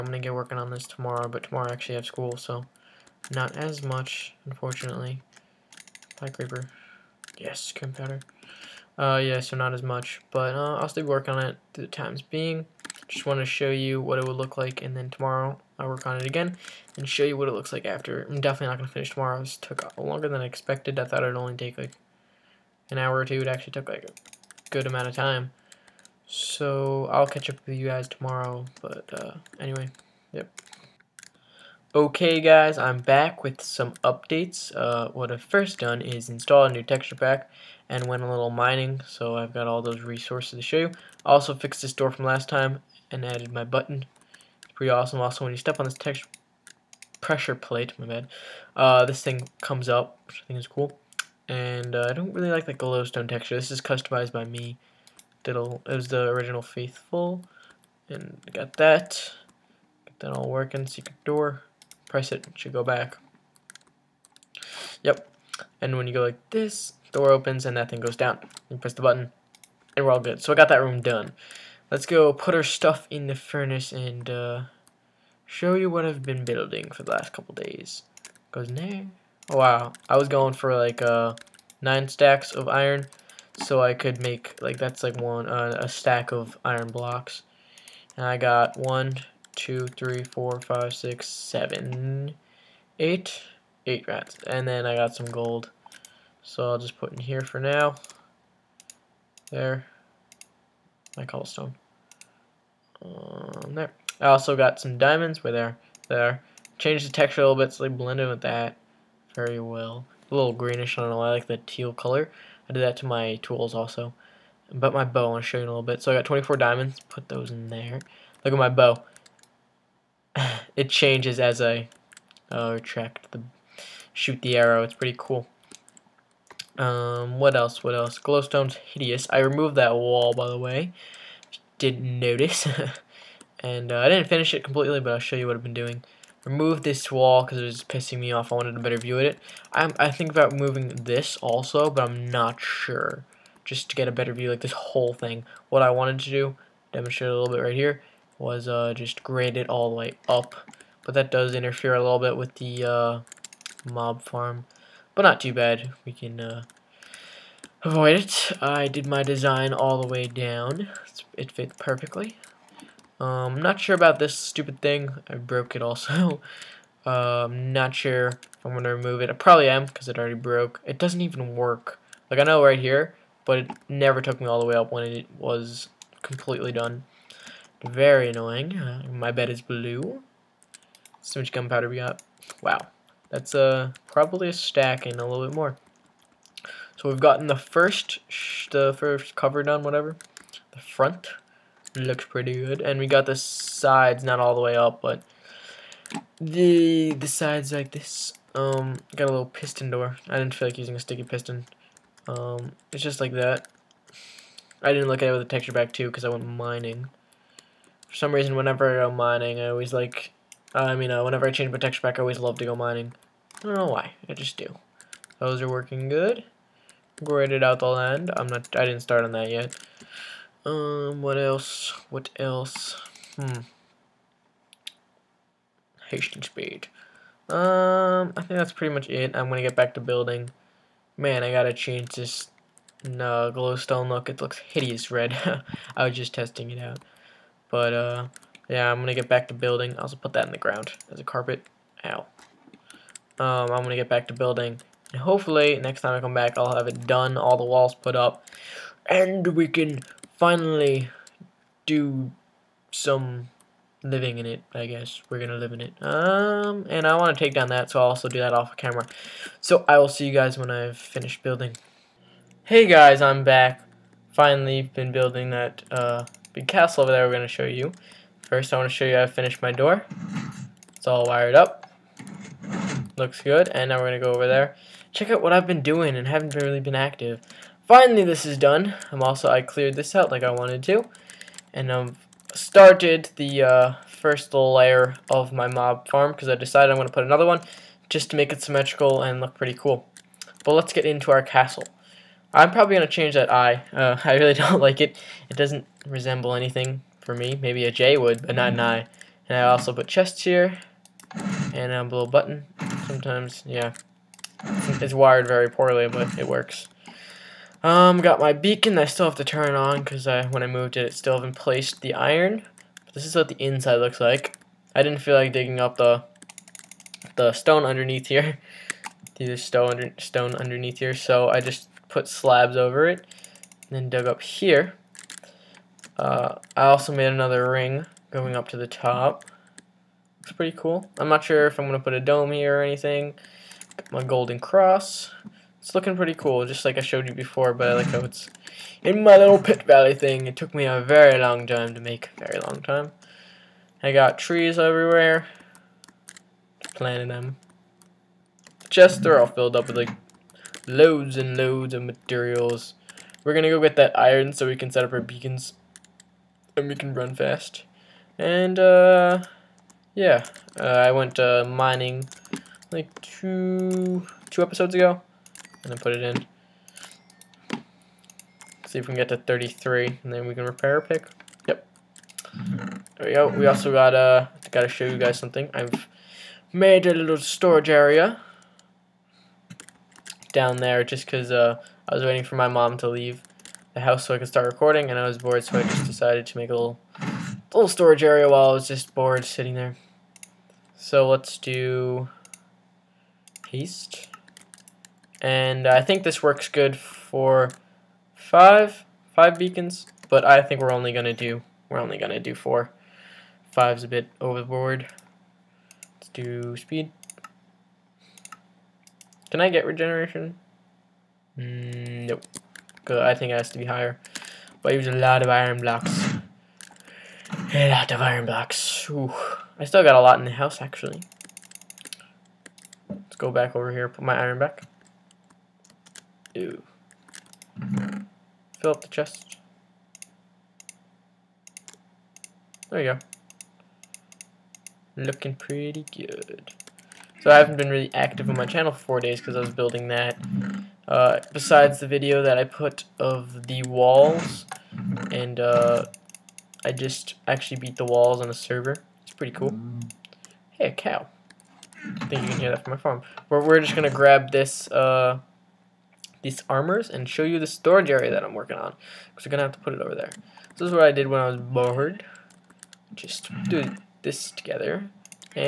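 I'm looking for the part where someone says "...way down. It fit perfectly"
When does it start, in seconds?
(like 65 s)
160 s.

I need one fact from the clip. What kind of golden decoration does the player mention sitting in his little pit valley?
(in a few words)
Golden cross.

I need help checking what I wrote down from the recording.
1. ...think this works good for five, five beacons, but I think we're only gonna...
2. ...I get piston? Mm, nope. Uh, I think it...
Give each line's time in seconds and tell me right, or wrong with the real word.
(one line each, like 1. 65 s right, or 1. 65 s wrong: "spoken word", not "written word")
1. 396 s right
2. 409 s wrong: "regeneration", not "piston".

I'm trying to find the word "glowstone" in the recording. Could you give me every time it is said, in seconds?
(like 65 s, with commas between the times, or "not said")
52 s, 128 s, 233 s.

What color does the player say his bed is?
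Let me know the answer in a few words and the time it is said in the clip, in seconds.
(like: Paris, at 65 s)
Blue, at 179 s.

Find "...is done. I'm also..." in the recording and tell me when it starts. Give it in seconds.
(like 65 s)
278 s.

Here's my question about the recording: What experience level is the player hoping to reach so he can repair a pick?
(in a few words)
33.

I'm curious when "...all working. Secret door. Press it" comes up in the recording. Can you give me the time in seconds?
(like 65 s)
60 s.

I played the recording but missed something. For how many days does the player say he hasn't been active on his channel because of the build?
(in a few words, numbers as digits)
4.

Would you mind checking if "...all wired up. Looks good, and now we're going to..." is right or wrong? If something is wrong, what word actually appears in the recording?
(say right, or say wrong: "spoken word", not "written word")
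right.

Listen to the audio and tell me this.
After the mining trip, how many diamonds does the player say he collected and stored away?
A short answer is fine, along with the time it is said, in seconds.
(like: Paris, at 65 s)
24, at 116 s.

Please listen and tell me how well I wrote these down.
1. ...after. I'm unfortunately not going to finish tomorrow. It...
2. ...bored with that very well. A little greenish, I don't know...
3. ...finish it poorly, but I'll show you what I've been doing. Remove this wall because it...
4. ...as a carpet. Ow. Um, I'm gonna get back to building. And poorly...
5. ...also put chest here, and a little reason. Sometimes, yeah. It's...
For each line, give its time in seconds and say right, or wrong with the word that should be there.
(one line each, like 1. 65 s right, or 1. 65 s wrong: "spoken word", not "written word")
1. 17 s wrong: "definitely", not "unfortunately"
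2. 107 s wrong: "blended", not "bored"
3. 134 s wrong: "completely", not "poorly"
4. 241 s wrong: "hopefully", not "poorly"
5. 299 s wrong: "button", not "reason".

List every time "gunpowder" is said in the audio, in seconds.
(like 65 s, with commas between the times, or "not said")
7 s, 181 s.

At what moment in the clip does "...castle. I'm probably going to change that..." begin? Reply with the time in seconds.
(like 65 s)
291 s.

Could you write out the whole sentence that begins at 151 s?
But that does interfere a little bit with the...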